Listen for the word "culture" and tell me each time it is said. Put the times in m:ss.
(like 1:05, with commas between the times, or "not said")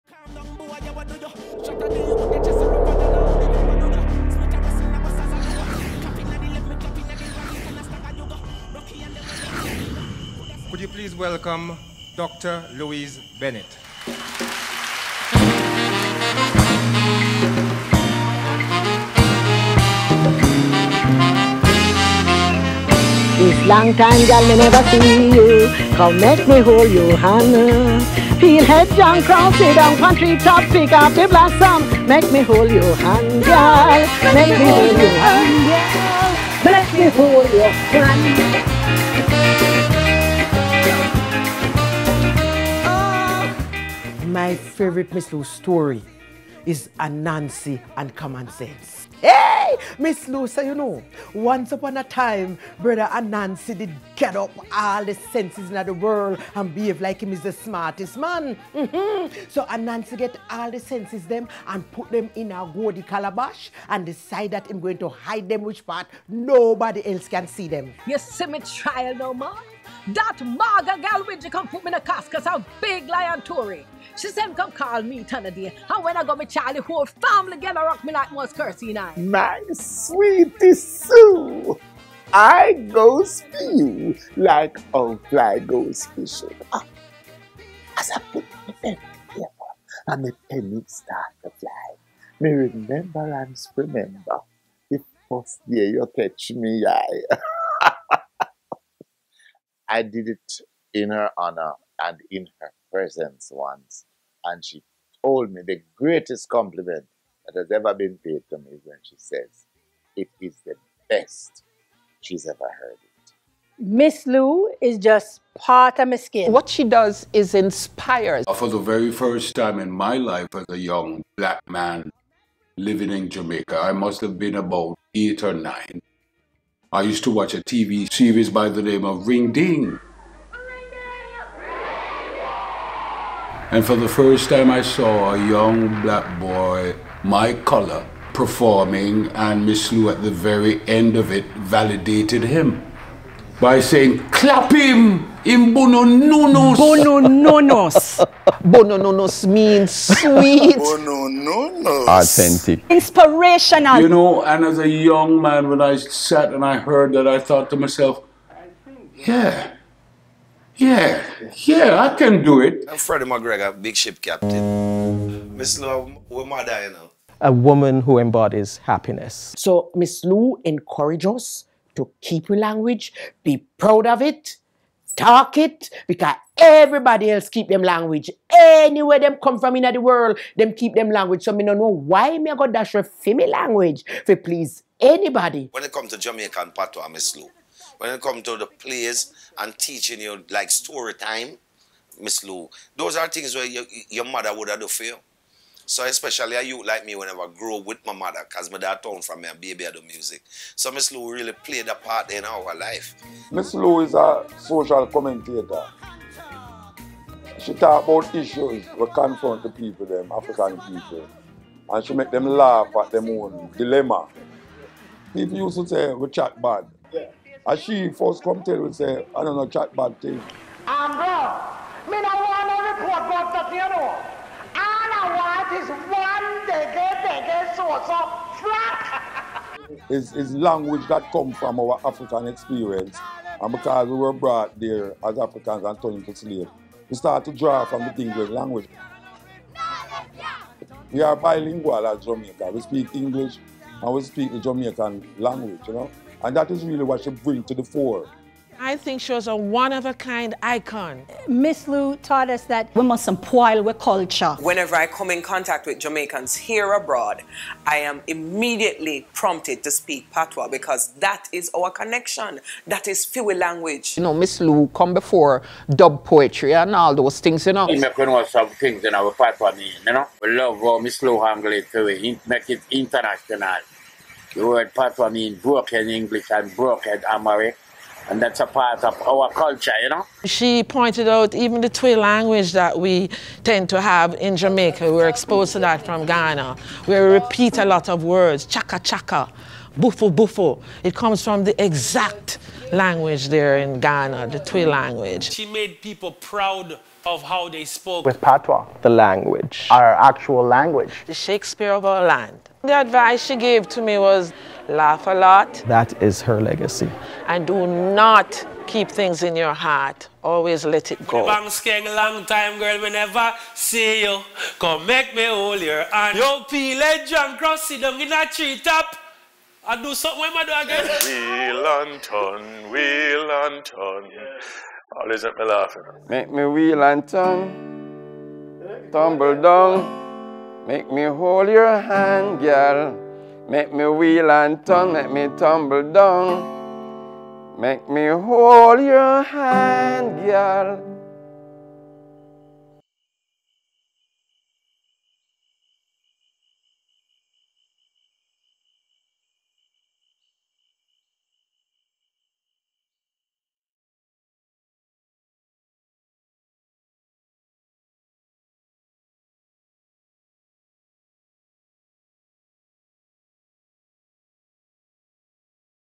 4:13, 4:39.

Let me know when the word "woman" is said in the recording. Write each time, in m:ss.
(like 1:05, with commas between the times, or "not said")
2:47.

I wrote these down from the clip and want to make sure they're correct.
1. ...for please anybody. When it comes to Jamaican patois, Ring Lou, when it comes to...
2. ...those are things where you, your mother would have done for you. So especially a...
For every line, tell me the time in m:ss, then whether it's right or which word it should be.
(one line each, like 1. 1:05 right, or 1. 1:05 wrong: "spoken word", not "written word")
1. 3:04 wrong: "Miss", not "Ring"
2. 3:12 right.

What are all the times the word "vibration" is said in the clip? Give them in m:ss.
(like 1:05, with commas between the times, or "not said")
not said.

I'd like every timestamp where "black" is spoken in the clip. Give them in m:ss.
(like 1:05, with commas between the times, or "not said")
2:01, 2:16.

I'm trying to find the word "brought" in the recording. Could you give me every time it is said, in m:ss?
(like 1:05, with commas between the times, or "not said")
3:54.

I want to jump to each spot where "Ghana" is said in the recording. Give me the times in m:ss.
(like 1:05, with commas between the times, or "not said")
4:46, 4:53.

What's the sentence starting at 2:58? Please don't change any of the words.
Anywhere them come from in the world, them keep them language.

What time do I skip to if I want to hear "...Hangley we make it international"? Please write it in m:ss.
4:31.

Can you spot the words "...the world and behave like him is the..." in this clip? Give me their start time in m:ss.
0:55.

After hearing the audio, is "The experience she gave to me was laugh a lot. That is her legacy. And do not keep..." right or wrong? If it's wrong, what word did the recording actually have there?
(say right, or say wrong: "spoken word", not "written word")
wrong: "advice", not "experience".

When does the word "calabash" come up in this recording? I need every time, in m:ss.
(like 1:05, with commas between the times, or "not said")
1:03.